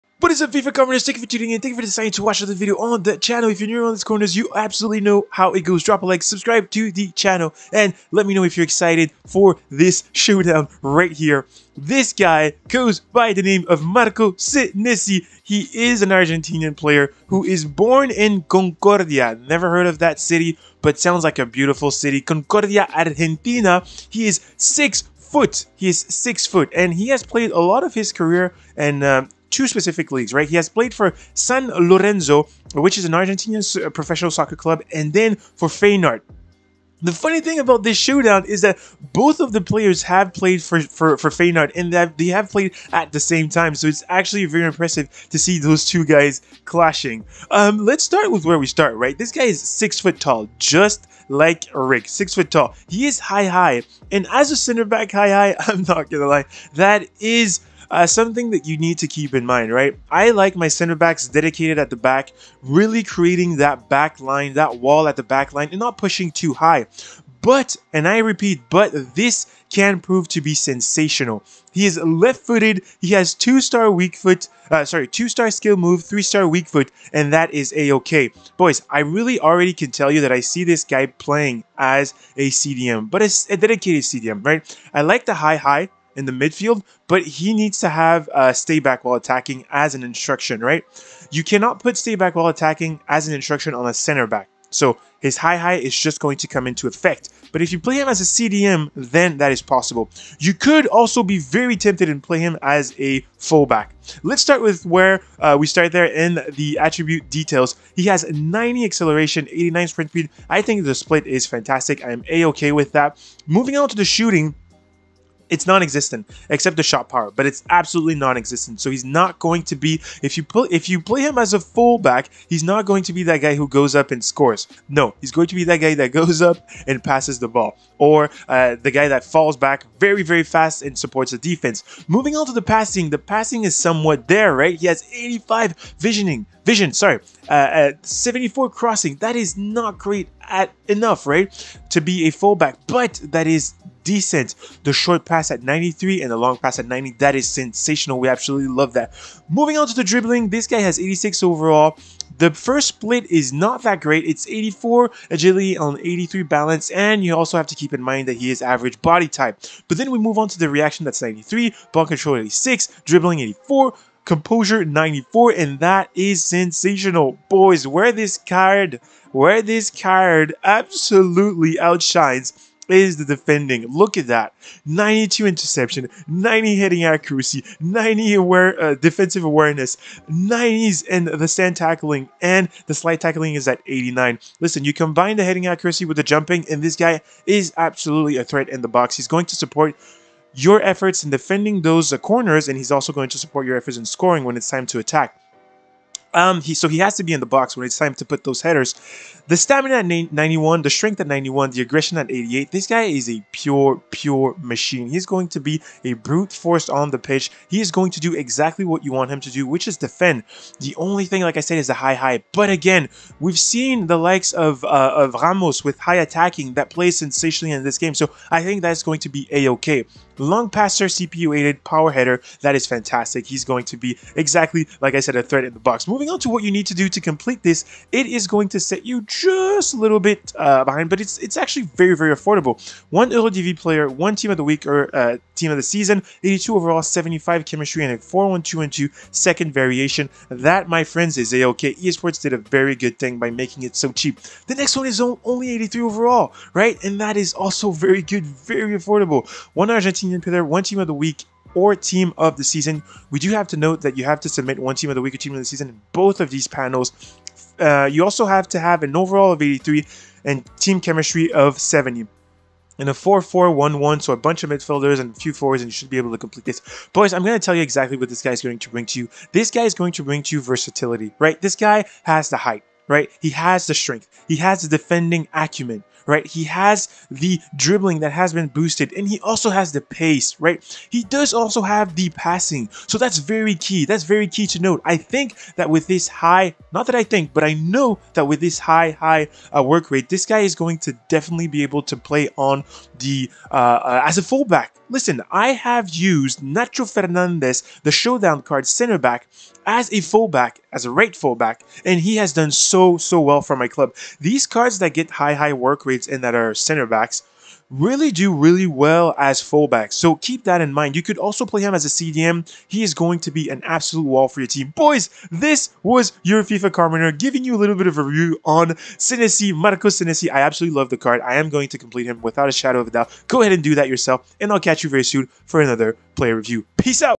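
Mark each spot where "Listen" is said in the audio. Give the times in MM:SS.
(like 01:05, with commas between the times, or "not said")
03:04, 04:55.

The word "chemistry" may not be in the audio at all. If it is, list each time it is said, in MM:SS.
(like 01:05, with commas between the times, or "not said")
03:57, 04:20.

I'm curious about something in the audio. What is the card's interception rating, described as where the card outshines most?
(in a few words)
92.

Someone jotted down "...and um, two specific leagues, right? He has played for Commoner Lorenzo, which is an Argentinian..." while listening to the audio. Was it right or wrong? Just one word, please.
wrong.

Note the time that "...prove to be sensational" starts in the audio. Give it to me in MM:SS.
01:09.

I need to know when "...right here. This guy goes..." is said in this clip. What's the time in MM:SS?
00:10.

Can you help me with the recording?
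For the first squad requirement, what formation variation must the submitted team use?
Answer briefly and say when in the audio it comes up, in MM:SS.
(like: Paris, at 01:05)
4-1-2-2, at 03:58.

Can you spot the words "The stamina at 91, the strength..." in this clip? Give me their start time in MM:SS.
03:19.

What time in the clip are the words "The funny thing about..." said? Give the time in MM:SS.
00:37.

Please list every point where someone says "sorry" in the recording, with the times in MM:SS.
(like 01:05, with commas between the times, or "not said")
01:14, 02:16.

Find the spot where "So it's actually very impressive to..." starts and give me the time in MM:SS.
00:43.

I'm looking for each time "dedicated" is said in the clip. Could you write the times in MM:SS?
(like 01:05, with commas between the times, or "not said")
01:01, 01:23.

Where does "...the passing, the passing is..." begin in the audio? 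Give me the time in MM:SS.
02:12.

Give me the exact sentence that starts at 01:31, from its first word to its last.
You cannot put stay back while attacking as an instruction on a center back.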